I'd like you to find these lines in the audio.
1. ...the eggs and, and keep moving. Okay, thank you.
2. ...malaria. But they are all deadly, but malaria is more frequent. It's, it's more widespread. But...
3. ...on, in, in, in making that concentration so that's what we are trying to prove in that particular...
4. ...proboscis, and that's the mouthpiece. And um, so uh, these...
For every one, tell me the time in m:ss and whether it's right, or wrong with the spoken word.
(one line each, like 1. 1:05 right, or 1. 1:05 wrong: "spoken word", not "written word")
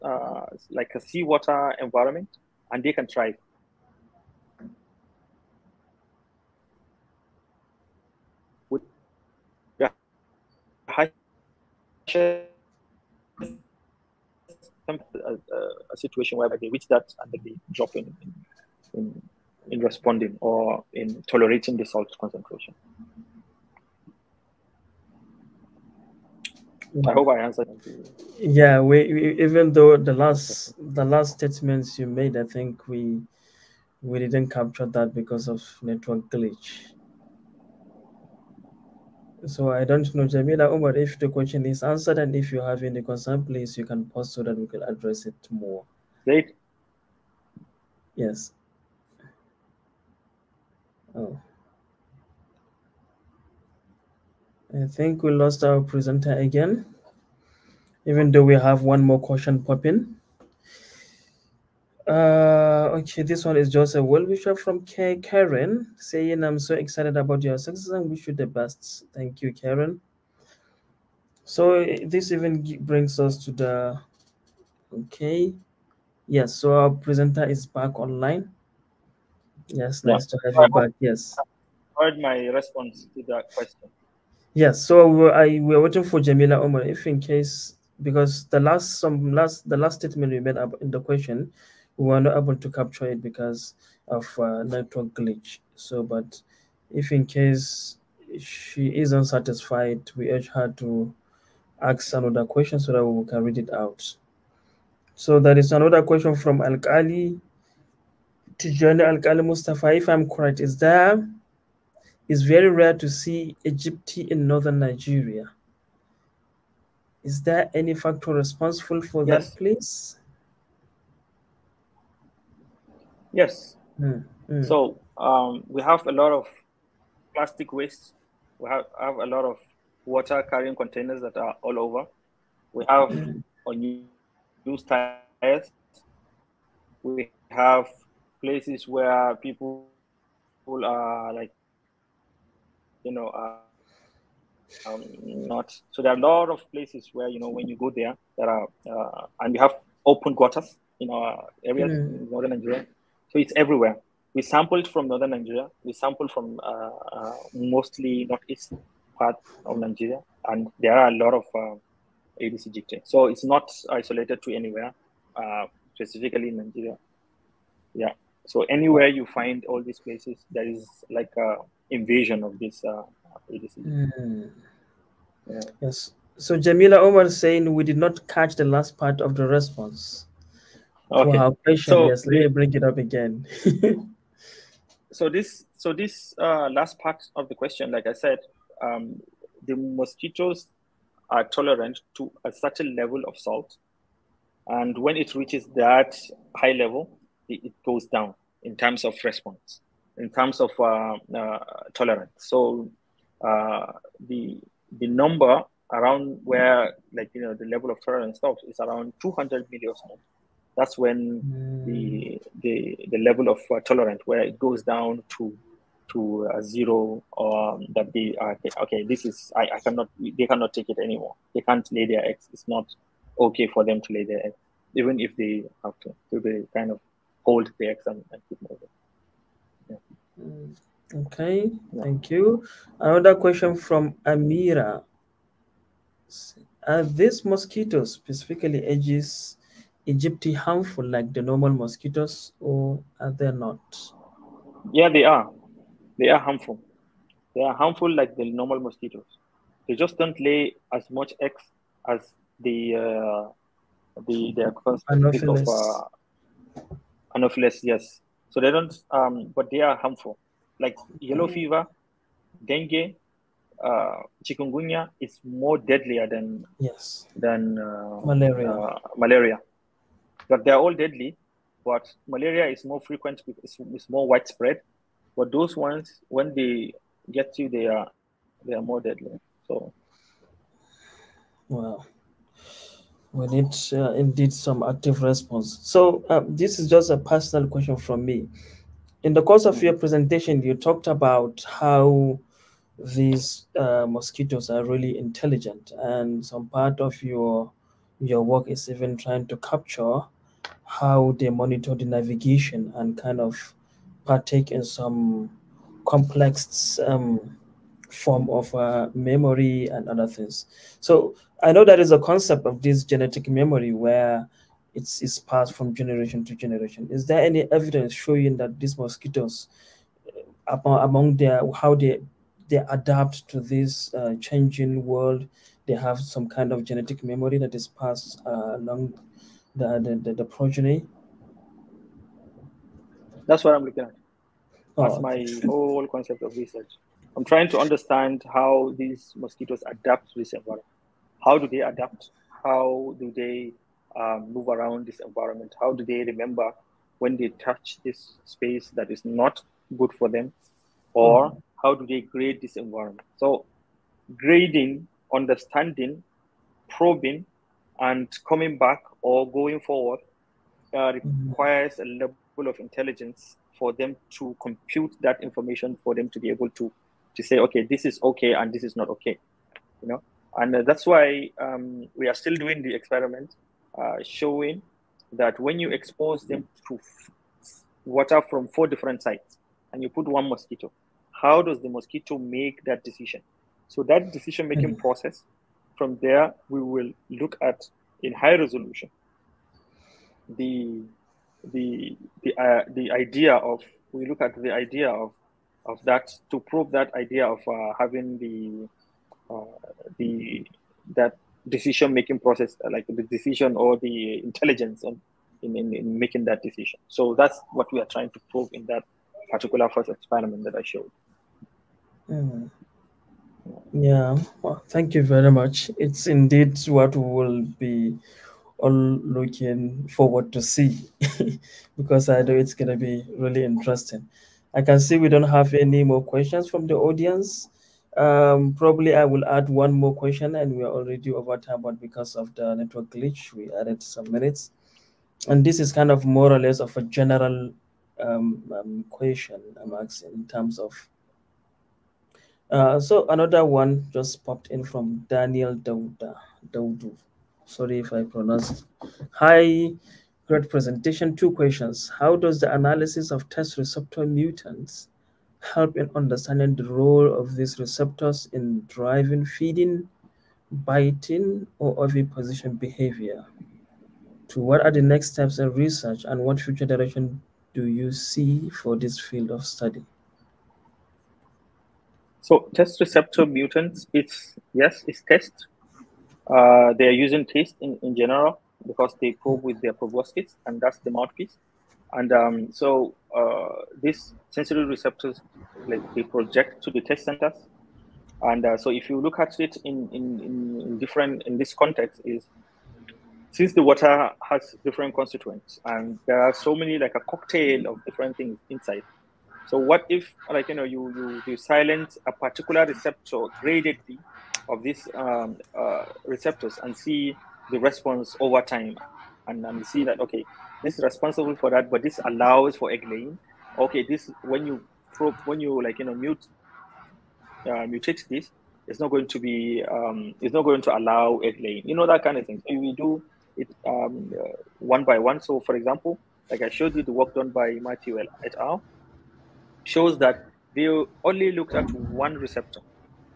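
1. 3:47 right
2. 4:29 right
3. 6:45 wrong: "decision", not "concentration"
4. 7:59 right.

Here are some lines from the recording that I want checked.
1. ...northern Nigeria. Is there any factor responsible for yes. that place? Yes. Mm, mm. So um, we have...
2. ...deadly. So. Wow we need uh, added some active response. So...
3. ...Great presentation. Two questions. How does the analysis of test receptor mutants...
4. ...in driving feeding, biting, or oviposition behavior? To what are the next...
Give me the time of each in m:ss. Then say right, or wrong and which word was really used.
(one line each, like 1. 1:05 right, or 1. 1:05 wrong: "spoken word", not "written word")
1. 1:54 right
2. 4:39 wrong: "indeed", not "added"
3. 7:30 right
4. 7:38 right.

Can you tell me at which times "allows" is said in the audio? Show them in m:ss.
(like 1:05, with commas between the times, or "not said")
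8:32, 8:40.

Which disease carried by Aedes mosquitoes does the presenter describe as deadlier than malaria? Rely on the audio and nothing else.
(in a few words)
Chikungunya.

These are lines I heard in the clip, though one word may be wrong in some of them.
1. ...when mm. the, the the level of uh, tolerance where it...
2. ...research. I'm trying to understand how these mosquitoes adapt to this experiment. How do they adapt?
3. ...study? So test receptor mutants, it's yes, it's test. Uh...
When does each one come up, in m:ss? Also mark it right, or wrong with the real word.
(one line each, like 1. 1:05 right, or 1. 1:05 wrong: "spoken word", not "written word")
1. 3:30 right
2. 5:36 wrong: "environment", not "experiment"
3. 7:49 right.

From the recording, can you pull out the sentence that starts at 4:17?
Yes, so they don't, um, but they are harmful.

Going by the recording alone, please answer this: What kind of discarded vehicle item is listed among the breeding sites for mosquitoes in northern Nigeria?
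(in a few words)
Unused tires.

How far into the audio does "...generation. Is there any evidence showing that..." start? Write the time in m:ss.
5:16.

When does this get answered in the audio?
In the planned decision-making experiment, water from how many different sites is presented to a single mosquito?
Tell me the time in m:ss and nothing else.
6:18.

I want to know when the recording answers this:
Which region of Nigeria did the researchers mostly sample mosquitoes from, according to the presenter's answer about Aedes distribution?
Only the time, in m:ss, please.
2:38.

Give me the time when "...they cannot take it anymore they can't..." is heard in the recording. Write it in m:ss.
3:40.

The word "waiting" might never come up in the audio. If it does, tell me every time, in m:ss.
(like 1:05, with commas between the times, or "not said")
1:25.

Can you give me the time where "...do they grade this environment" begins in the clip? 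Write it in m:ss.
5:51.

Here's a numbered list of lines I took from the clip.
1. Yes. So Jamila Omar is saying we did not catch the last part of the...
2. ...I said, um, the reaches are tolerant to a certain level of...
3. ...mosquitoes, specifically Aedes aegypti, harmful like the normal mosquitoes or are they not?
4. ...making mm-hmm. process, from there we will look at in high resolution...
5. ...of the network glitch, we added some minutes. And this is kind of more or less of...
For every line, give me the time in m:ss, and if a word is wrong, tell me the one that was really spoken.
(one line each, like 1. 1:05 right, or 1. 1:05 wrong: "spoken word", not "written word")
1. 2:55 right
2. 3:08 wrong: "mosquitoes", not "reaches"
3. 3:57 right
4. 6:24 right
5. 7:12 right.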